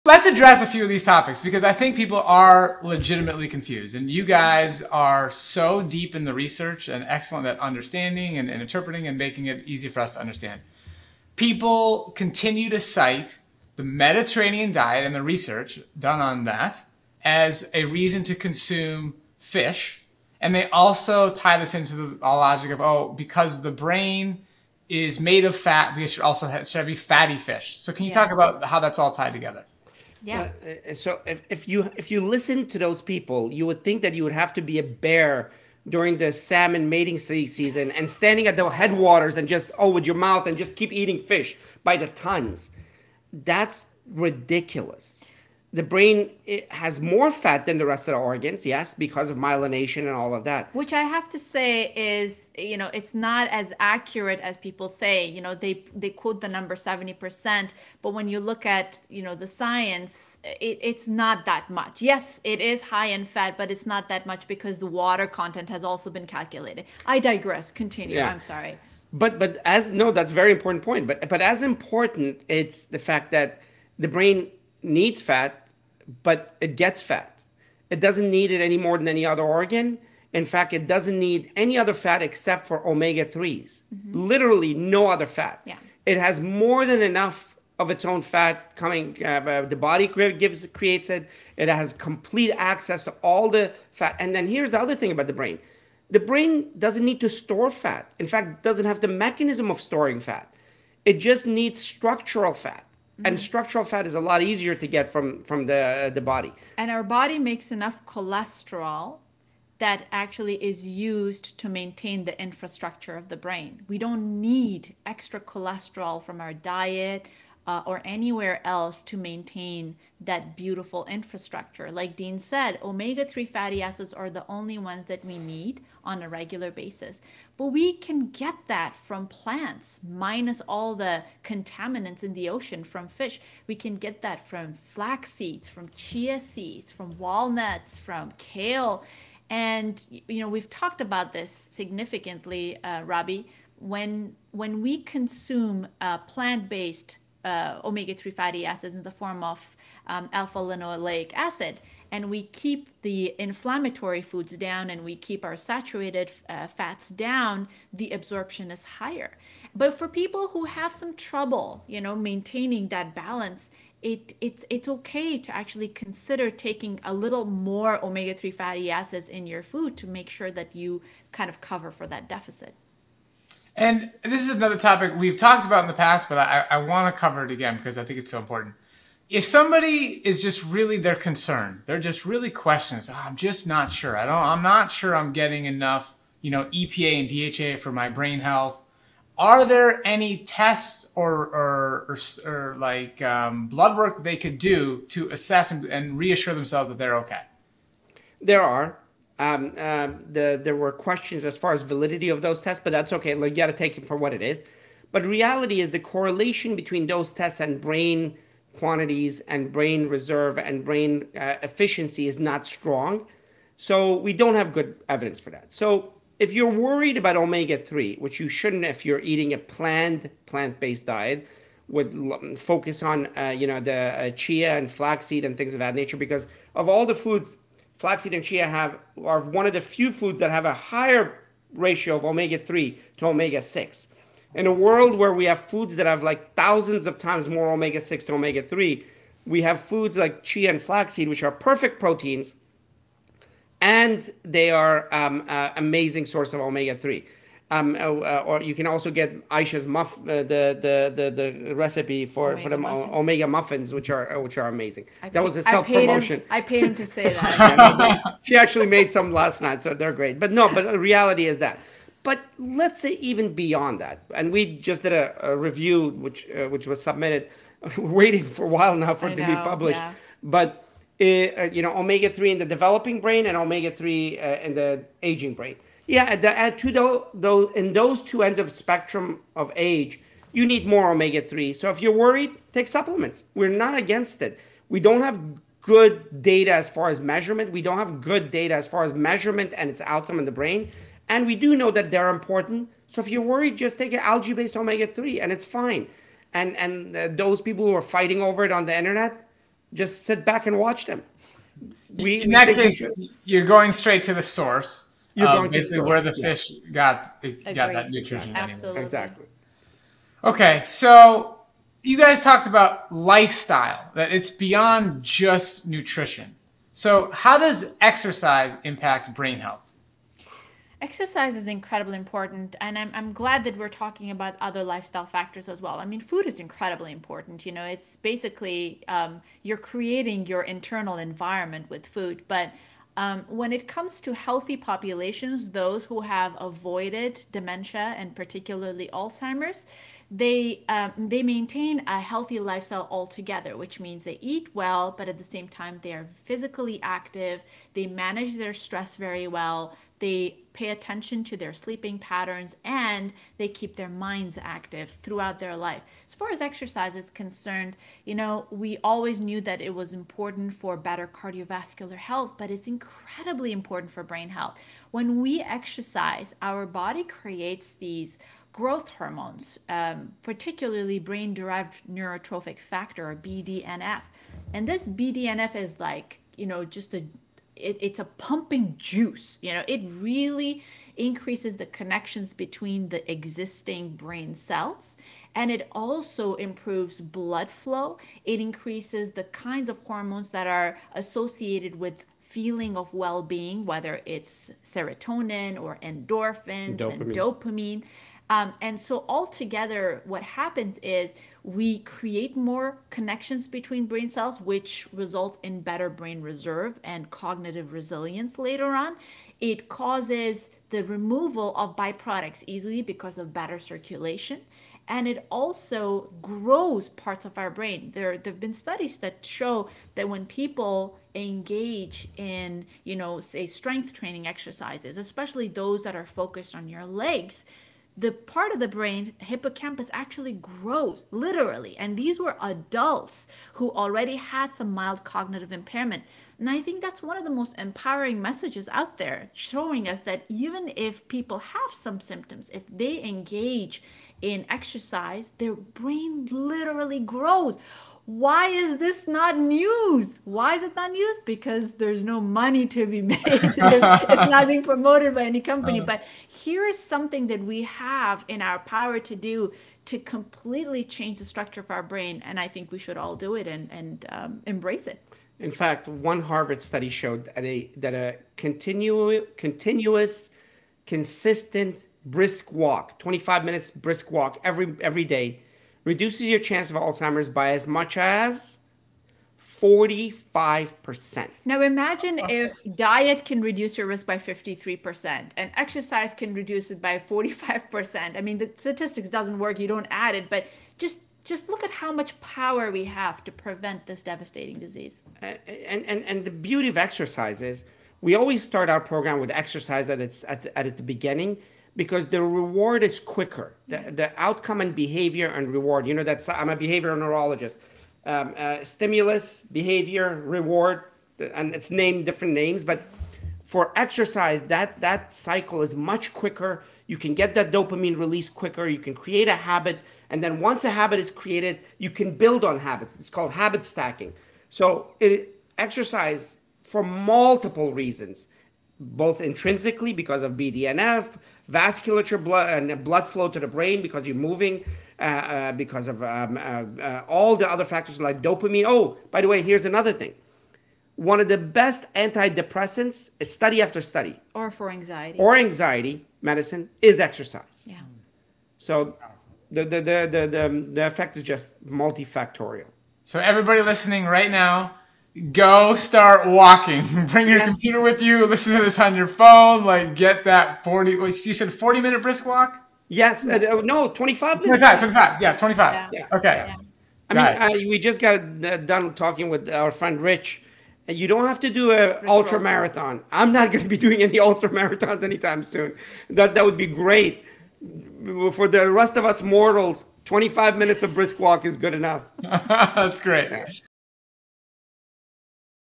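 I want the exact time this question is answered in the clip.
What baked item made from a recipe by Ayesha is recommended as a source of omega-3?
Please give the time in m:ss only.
4:13.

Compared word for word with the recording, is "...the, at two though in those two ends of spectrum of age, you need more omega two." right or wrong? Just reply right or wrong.
wrong.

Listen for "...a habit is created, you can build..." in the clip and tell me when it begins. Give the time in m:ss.
8:40.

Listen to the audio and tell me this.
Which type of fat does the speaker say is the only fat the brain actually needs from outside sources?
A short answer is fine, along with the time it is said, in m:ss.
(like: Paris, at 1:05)
omega 3s, at 1:22.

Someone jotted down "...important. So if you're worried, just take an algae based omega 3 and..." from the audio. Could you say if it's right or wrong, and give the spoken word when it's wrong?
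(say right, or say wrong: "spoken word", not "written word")
right.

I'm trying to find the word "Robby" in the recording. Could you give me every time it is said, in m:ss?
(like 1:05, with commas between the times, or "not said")
2:23.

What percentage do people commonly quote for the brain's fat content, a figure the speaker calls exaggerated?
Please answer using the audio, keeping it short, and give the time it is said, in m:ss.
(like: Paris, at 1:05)
70%, at 0:56.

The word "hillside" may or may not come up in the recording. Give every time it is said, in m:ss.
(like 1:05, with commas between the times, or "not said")
not said.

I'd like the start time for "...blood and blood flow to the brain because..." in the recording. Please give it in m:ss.
8:52.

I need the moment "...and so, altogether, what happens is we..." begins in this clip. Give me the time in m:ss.
6:38.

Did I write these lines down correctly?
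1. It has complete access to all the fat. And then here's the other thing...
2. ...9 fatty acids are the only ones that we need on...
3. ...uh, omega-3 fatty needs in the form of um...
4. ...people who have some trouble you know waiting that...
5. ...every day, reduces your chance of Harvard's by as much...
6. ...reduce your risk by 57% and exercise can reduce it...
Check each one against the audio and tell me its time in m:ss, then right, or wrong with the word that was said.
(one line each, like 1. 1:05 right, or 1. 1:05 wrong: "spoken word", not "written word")
1. 1:31 right
2. 2:03 wrong: "3", not "9"
3. 2:27 wrong: "acids", not "needs"
4. 2:40 wrong: "maintaining", not "waiting"
5. 7:55 wrong: "Alzheimer", not "Harvard"
6. 8:03 wrong: "53", not "57".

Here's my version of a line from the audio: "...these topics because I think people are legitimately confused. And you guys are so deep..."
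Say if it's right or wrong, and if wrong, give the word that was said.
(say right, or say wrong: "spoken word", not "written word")
right.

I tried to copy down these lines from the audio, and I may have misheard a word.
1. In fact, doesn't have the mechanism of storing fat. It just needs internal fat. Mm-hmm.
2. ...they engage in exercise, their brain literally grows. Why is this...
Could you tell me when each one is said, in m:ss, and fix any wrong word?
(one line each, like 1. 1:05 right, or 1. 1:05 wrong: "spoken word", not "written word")
1. 1:38 wrong: "structural", not "internal"
2. 7:22 right.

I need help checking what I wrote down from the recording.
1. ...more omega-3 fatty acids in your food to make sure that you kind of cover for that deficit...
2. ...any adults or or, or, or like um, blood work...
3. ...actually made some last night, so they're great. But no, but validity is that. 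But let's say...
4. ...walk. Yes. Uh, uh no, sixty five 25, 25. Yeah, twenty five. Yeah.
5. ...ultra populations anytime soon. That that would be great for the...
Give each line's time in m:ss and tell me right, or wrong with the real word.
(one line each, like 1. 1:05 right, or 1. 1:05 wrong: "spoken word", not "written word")
1. 2:47 right
2. 3:10 wrong: "tests", not "adults"
3. 4:18 wrong: "reality", not "validity"
4. 9:22 wrong: "twenty", not "sixty"
5. 9:34 wrong: "marathons", not "populations".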